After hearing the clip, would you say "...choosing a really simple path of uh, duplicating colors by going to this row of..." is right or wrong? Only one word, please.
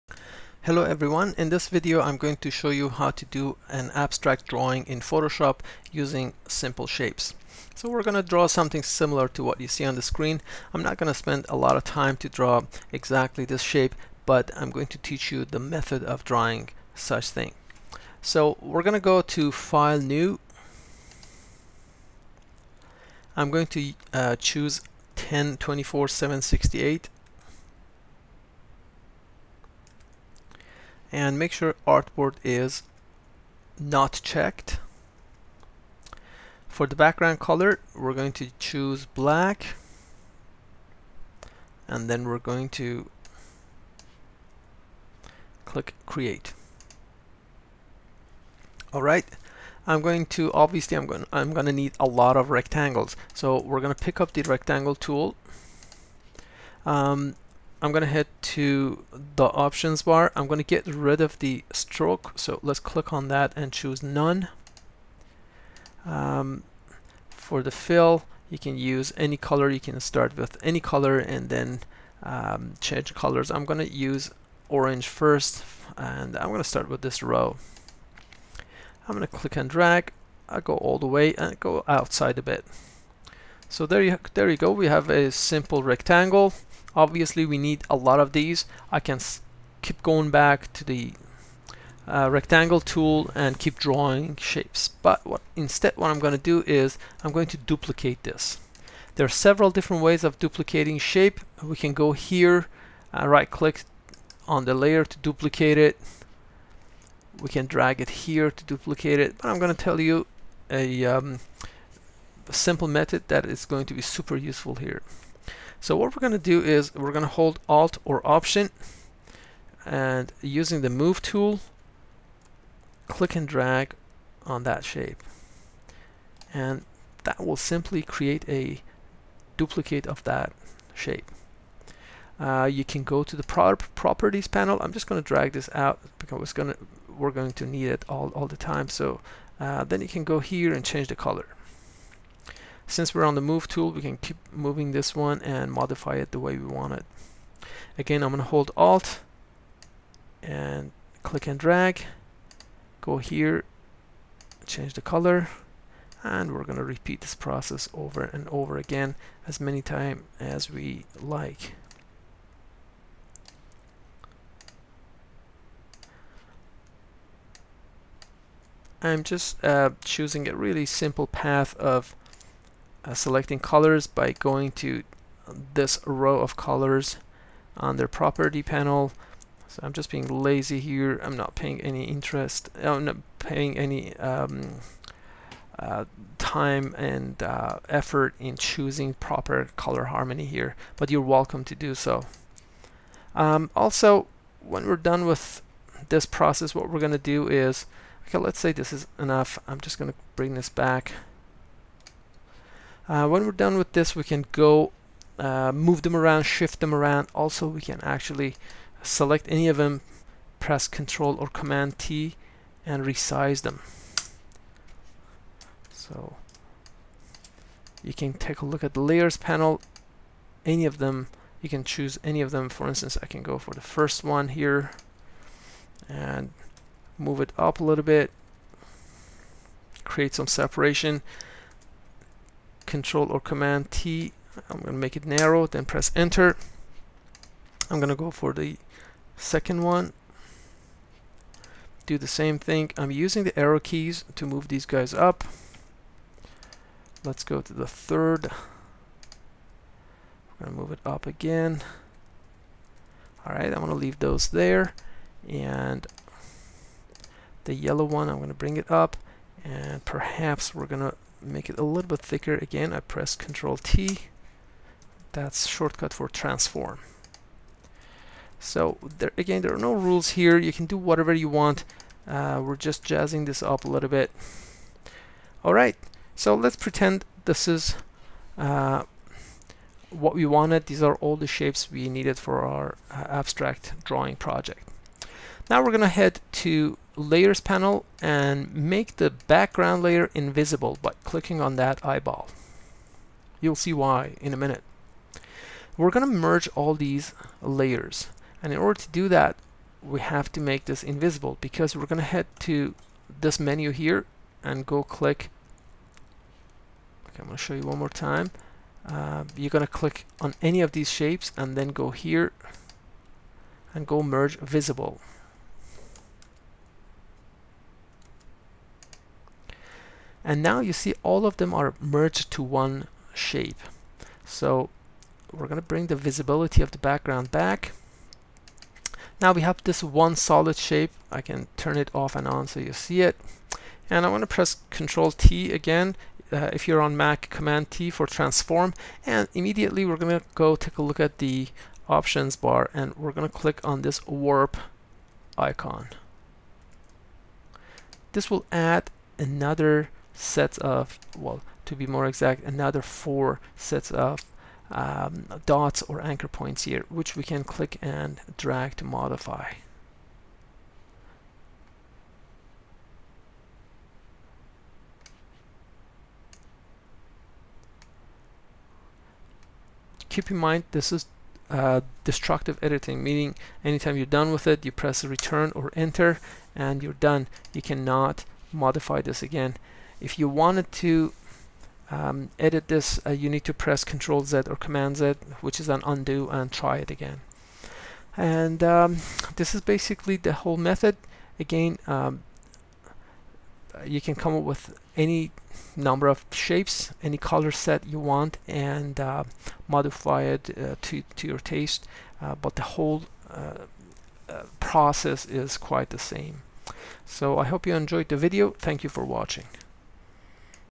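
wrong.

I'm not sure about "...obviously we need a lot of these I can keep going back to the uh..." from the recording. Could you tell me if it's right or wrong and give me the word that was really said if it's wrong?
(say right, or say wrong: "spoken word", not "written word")
right.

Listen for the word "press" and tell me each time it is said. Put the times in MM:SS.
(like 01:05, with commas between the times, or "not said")
03:30, 03:55, 04:23, 05:34, 06:14, 06:23.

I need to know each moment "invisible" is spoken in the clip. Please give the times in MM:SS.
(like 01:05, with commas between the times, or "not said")
04:50, 05:01.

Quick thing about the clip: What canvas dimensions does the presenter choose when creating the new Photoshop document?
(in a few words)
1024 x 768.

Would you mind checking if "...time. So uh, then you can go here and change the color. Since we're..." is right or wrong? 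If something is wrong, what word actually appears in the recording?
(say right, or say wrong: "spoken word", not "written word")
right.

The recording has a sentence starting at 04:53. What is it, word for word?
You'll see why in a minute.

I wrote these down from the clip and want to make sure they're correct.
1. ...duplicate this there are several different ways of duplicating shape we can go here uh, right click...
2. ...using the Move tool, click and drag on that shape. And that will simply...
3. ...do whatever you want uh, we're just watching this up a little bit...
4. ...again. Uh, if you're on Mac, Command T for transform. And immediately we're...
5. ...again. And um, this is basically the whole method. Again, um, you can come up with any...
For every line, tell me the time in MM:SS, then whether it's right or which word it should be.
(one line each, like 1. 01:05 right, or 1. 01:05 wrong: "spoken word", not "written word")
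1. 01:37 right
2. 02:00 right
3. 04:30 wrong: "jazzing", not "watching"
4. 05:35 right
5. 06:27 right.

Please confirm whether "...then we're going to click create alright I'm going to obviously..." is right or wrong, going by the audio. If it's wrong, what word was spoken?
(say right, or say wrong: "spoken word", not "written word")
right.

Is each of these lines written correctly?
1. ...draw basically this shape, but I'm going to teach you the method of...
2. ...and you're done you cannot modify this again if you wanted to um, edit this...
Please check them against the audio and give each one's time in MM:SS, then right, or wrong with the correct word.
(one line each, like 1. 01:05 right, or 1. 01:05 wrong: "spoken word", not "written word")
1. 00:12 wrong: "exactly", not "basically"
2. 06:16 right.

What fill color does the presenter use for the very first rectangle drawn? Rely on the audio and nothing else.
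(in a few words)
Orange.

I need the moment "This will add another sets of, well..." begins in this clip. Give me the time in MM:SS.
05:48.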